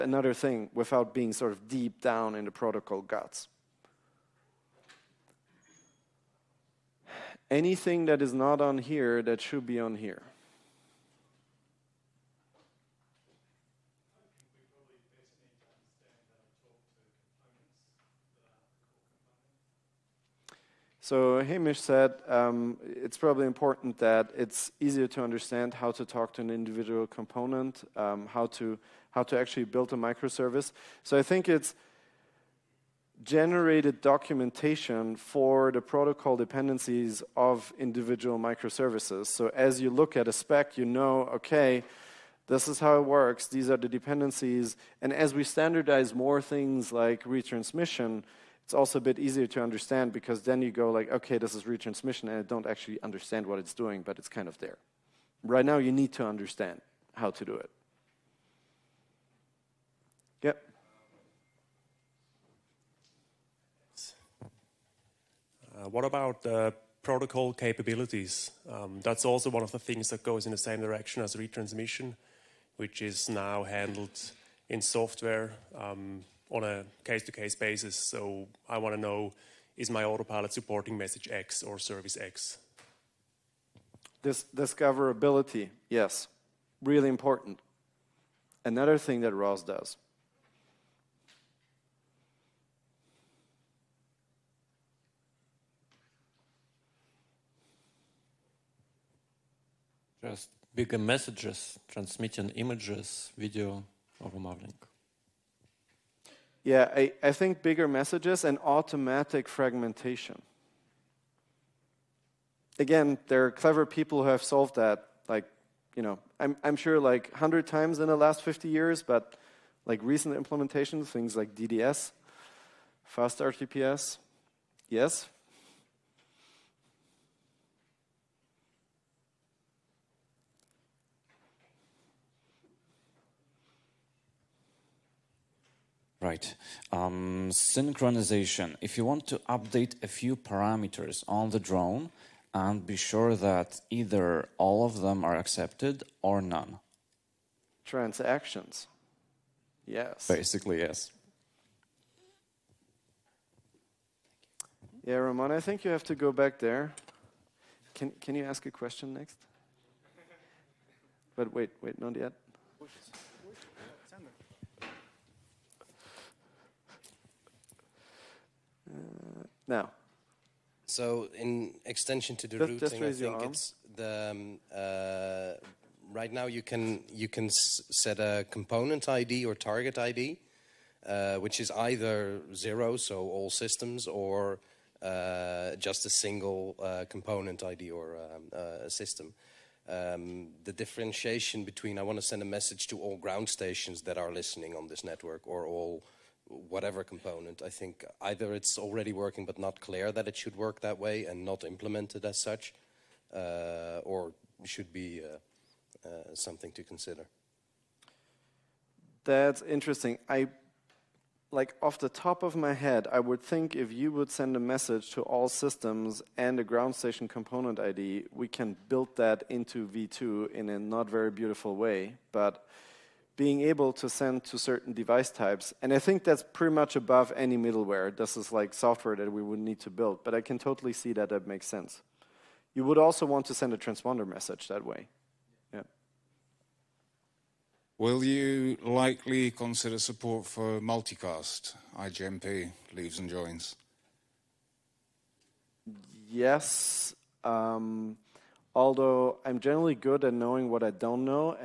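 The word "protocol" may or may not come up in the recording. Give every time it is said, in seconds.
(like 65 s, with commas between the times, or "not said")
2 s, 35 s, 67 s.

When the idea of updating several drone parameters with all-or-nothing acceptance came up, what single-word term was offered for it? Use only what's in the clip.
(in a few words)
Transactions.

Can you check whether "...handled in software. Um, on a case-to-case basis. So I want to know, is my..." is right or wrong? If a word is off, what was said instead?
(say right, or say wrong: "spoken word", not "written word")
right.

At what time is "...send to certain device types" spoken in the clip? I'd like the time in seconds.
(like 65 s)
224 s.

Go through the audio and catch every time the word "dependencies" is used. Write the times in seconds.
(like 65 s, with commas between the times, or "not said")
36 s, 43 s.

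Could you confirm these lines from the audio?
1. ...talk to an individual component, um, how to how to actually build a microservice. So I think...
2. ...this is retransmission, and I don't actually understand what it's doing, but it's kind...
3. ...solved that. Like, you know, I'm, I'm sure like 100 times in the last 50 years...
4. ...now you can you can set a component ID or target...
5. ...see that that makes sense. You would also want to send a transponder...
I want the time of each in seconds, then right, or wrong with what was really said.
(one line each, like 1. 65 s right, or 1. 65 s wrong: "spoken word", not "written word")
1. 26 s right
2. 51 s right
3. 114 s right
4. 176 s right
5. 230 s right.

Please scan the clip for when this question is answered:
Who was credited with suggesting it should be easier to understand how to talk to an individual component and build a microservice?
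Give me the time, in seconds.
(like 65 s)
21 s.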